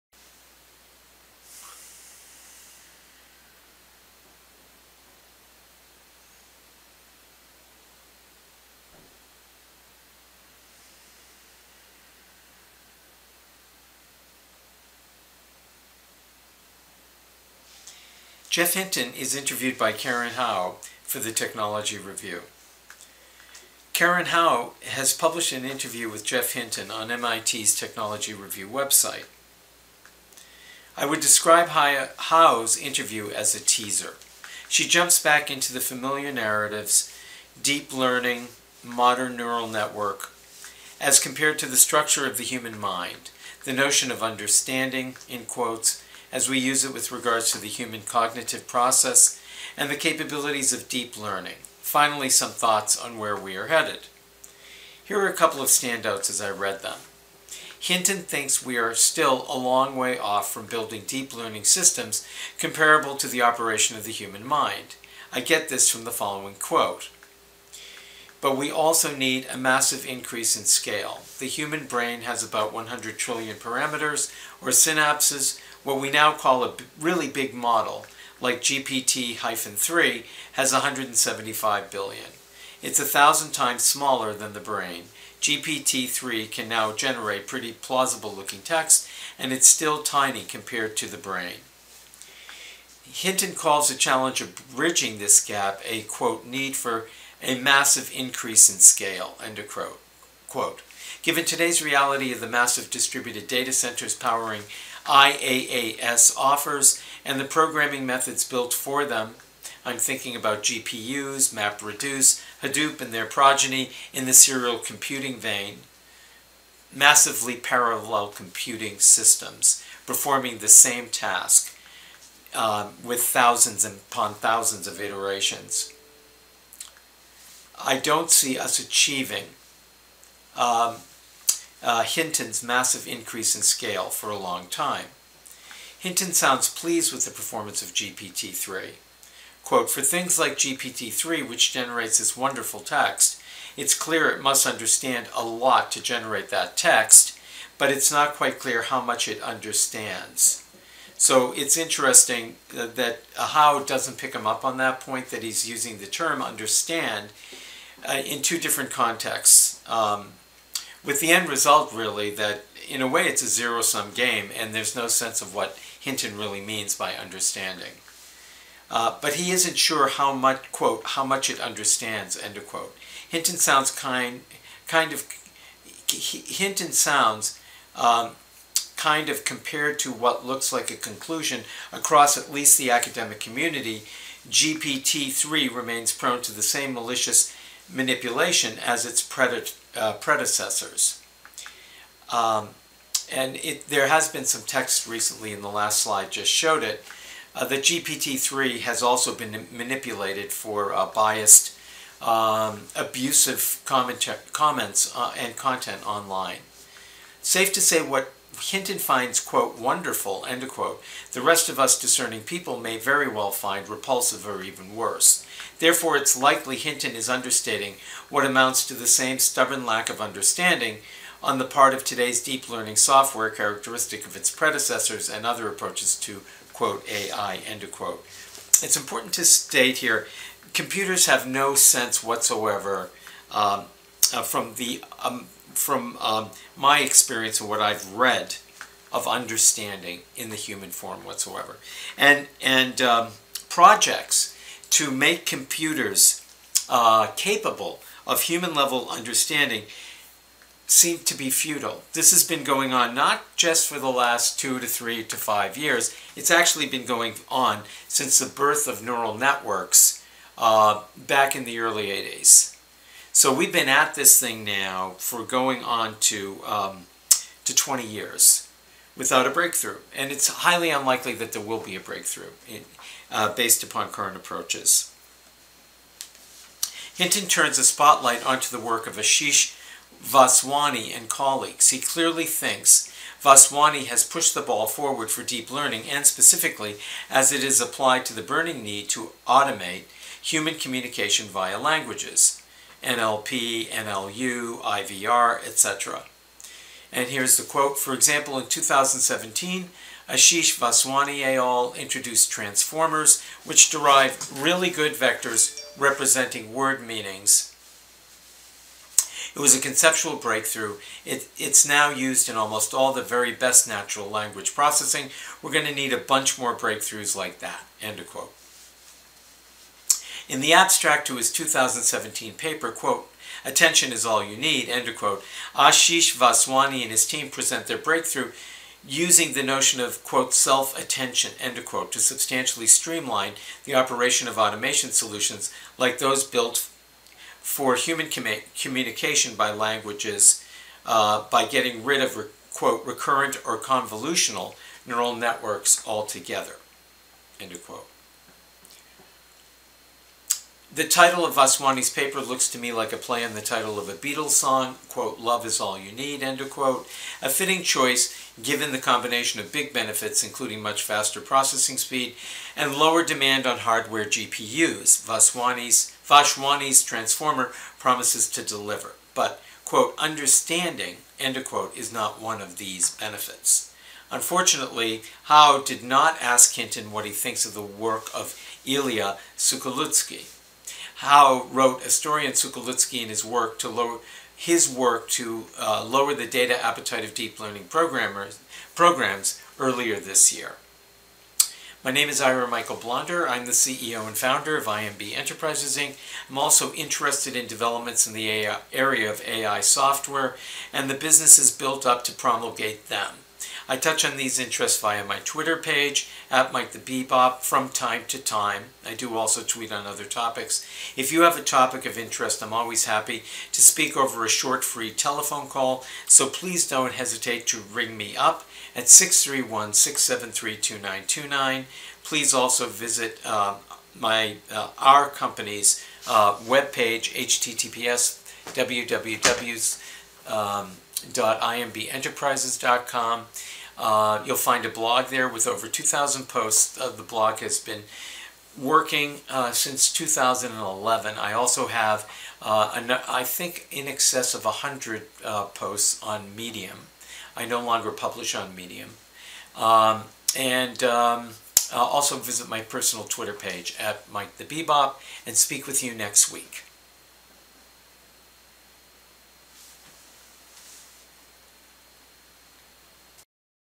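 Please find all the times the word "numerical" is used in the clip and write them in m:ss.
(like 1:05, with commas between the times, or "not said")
not said.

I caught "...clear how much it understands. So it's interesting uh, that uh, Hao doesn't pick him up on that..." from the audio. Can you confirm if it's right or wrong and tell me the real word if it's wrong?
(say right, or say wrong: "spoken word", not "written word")
right.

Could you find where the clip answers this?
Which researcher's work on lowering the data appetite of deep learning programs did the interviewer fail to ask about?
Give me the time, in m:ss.
6:18.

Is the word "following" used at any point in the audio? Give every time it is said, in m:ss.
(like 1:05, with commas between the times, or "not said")
1:06.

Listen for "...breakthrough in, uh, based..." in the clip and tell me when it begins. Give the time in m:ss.
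4:32.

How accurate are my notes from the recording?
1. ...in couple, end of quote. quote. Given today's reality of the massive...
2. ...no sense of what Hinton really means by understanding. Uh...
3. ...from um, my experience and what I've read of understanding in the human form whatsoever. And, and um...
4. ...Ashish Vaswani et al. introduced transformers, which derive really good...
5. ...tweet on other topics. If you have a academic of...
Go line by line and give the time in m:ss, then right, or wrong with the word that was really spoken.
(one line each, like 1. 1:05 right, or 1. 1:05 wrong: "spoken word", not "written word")
1. 1:38 wrong: "scale", not "couple"
2. 2:44 right
3. 3:55 right
4. 5:00 right
5. 6:49 wrong: "topic", not "academic".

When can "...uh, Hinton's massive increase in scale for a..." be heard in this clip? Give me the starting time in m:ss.
2:11.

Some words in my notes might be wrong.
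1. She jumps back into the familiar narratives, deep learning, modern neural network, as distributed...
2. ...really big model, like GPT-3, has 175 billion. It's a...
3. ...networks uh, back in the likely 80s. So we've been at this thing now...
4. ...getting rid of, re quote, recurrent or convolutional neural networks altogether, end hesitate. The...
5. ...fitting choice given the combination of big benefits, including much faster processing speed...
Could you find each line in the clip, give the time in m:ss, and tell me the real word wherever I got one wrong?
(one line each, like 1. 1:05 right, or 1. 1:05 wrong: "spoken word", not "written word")
1. 0:34 wrong: "compared", not "distributed"
2. 1:16 right
3. 4:19 wrong: "early", not "likely"
4. 5:41 wrong: "quote", not "hesitate"
5. 5:57 right.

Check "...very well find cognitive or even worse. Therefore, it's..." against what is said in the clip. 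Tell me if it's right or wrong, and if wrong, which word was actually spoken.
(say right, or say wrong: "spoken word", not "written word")
wrong: "repulsive", not "cognitive".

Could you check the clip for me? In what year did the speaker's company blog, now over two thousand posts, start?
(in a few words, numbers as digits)
2011.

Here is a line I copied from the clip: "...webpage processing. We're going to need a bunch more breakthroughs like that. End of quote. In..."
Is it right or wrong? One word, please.
wrong.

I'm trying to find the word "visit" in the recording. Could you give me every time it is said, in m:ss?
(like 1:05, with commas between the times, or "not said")
7:02, 7:32.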